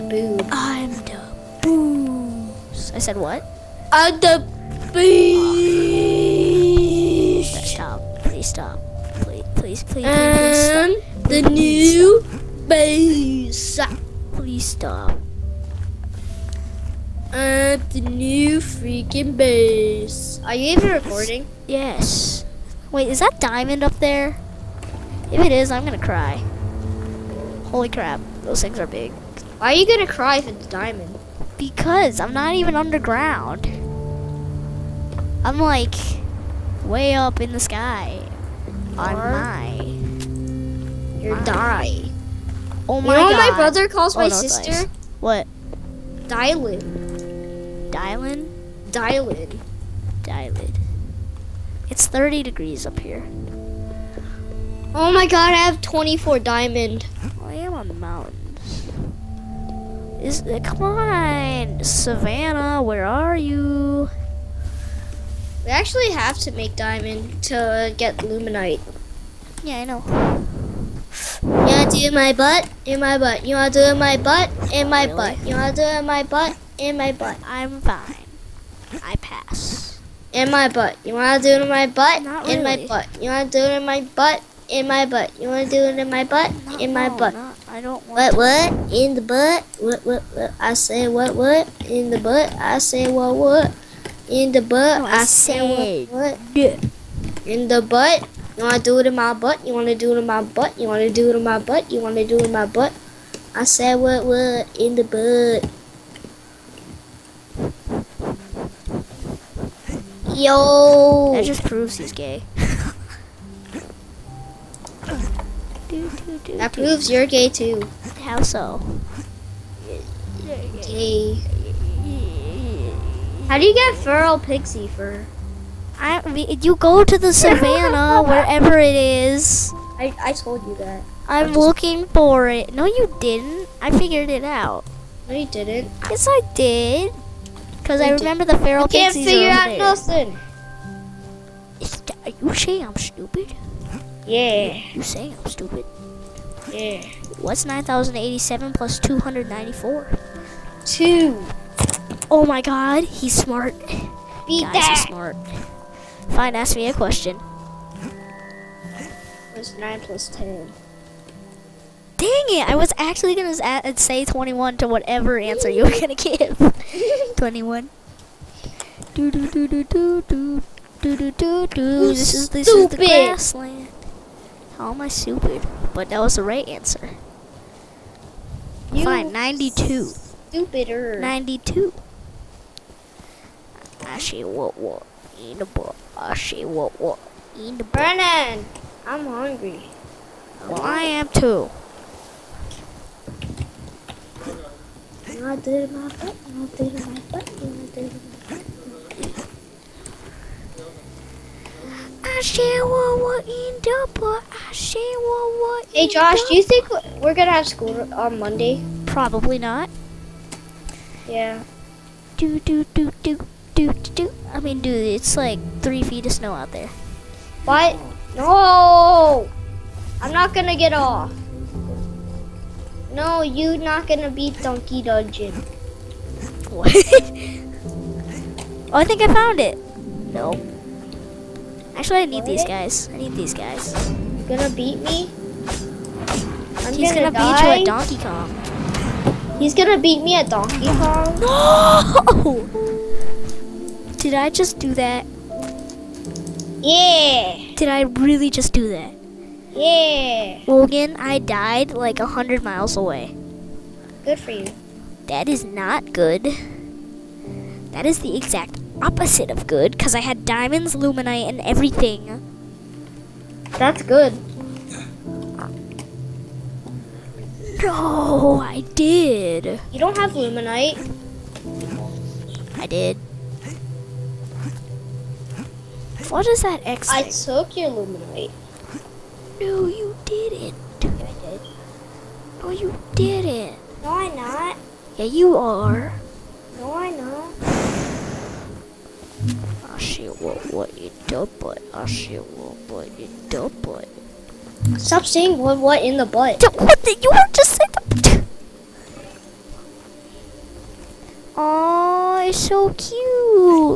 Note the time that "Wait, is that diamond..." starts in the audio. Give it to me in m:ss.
0:22.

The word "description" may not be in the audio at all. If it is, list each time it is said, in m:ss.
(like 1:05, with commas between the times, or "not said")
not said.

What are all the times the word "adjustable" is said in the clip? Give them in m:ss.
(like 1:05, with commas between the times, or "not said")
not said.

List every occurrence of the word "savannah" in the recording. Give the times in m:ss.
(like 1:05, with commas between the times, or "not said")
1:01, 2:07.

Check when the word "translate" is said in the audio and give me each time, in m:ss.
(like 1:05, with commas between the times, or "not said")
not said.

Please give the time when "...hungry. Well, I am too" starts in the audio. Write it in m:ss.
3:09.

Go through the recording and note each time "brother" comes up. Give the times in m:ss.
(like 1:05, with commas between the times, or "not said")
0:43.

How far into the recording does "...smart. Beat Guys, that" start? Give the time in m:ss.
2:33.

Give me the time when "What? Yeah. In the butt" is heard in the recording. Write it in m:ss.
1:36.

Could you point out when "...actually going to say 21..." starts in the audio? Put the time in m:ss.
2:42.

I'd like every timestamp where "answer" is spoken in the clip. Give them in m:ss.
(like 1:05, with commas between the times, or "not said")
2:45, 2:56.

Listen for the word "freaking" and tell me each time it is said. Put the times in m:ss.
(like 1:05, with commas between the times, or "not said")
0:18.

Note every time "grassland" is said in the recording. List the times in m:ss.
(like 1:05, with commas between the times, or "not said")
2:53.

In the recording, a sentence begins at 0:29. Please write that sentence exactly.
Why are you gonna cry if it's diamond?